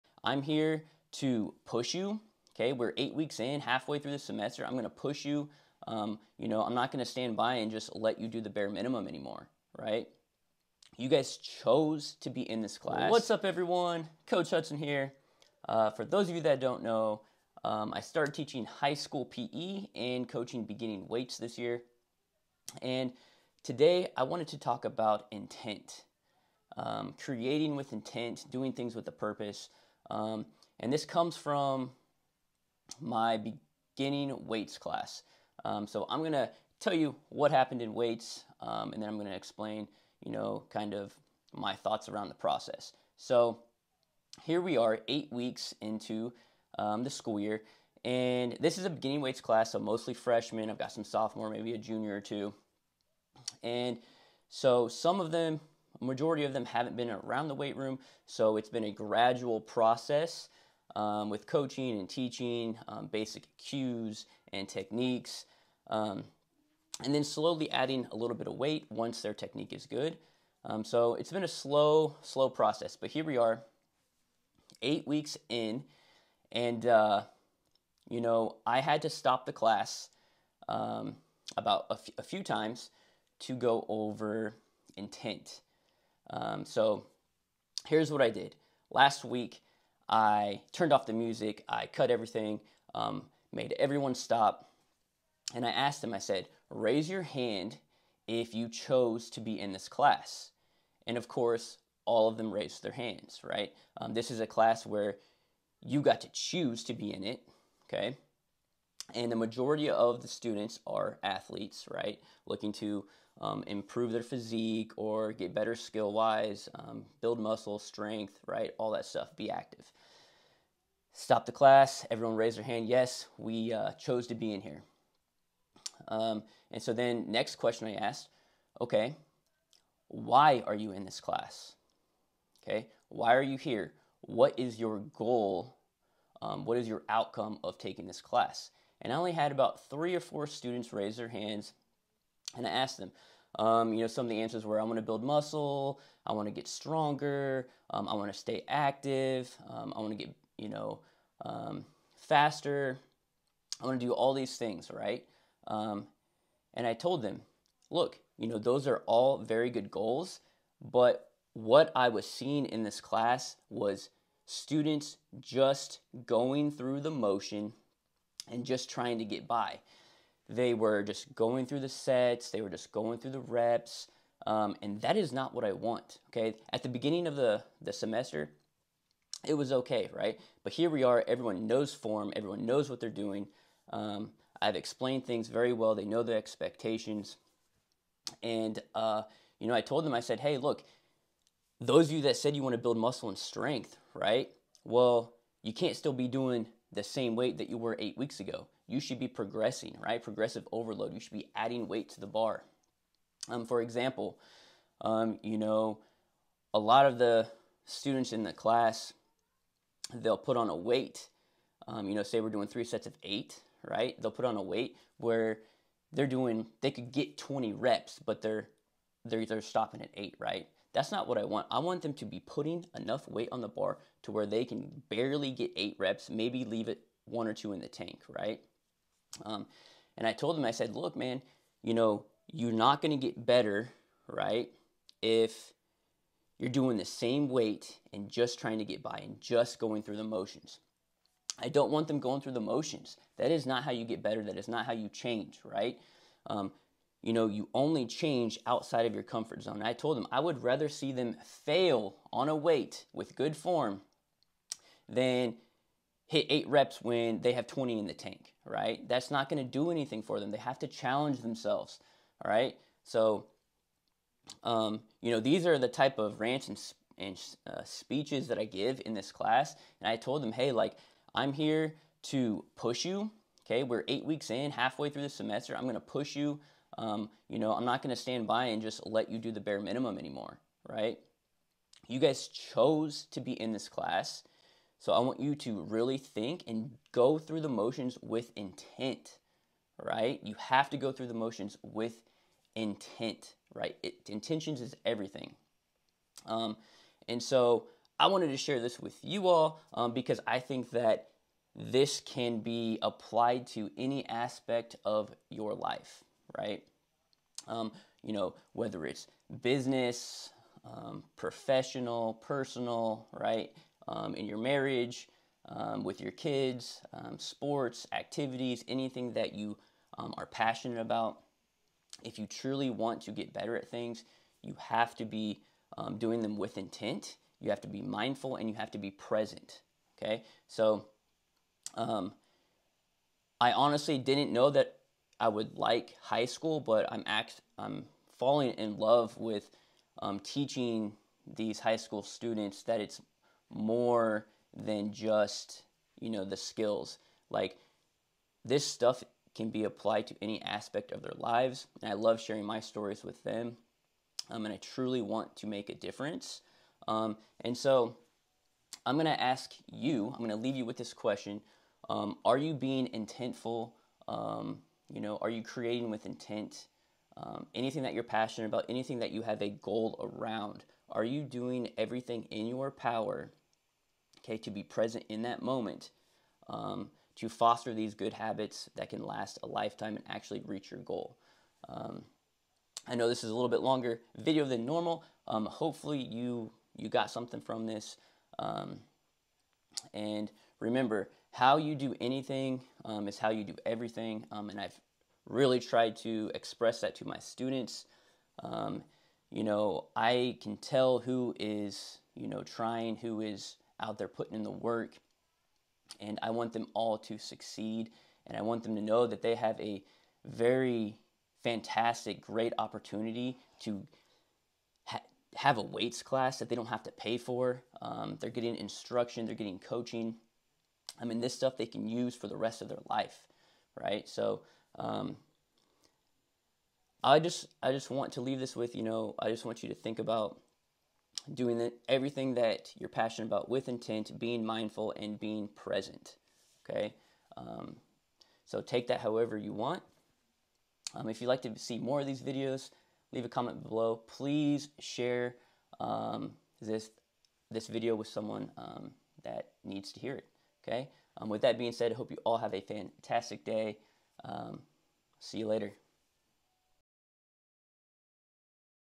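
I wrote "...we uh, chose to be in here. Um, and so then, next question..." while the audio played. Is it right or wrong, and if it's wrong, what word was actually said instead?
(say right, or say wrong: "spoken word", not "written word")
right.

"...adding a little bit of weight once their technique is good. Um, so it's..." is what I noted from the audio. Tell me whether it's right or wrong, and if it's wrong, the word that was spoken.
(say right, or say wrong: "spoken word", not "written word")
right.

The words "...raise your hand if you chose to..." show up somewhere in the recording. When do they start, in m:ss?
1:36.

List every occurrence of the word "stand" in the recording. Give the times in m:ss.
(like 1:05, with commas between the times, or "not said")
0:07, 4:38.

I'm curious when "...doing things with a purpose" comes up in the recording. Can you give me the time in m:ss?
0:28.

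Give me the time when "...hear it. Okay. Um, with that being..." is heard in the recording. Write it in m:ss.
7:30.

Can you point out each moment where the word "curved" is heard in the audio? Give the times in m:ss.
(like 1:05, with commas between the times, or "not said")
not said.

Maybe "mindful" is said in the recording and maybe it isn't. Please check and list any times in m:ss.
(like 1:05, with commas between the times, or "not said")
5:28, 7:14.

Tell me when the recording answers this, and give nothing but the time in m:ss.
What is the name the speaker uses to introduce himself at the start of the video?
0:14.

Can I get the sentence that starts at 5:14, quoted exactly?
um, in your marriage, um, with your kids, um, sports, activities, anything that you um, are passionate about.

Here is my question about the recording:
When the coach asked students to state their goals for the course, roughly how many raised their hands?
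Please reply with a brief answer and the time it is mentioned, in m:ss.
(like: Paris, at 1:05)
three or four, at 2:19.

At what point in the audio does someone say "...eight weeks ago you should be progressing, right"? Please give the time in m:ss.
3:17.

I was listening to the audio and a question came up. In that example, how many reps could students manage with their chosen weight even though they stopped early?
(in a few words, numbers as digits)
20.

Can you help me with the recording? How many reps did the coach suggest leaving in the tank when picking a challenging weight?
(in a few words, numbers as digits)
one or two.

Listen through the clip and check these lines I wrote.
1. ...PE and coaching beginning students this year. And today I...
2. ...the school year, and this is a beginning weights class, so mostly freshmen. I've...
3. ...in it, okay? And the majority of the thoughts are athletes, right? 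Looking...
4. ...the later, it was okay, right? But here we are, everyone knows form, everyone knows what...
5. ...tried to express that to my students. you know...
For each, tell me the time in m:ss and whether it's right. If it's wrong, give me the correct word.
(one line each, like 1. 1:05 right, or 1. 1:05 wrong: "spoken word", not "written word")
1. 0:19 wrong: "weights", not "students"
2. 0:47 right
3. 1:47 wrong: "students", not "thoughts"
4. 2:57 wrong: "semester", not "later"
5. 6:35 right.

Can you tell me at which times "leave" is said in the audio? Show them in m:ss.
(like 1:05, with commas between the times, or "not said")
3:46, 6:00, 7:08, 7:23.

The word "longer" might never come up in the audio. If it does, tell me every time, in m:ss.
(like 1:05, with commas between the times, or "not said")
6:23.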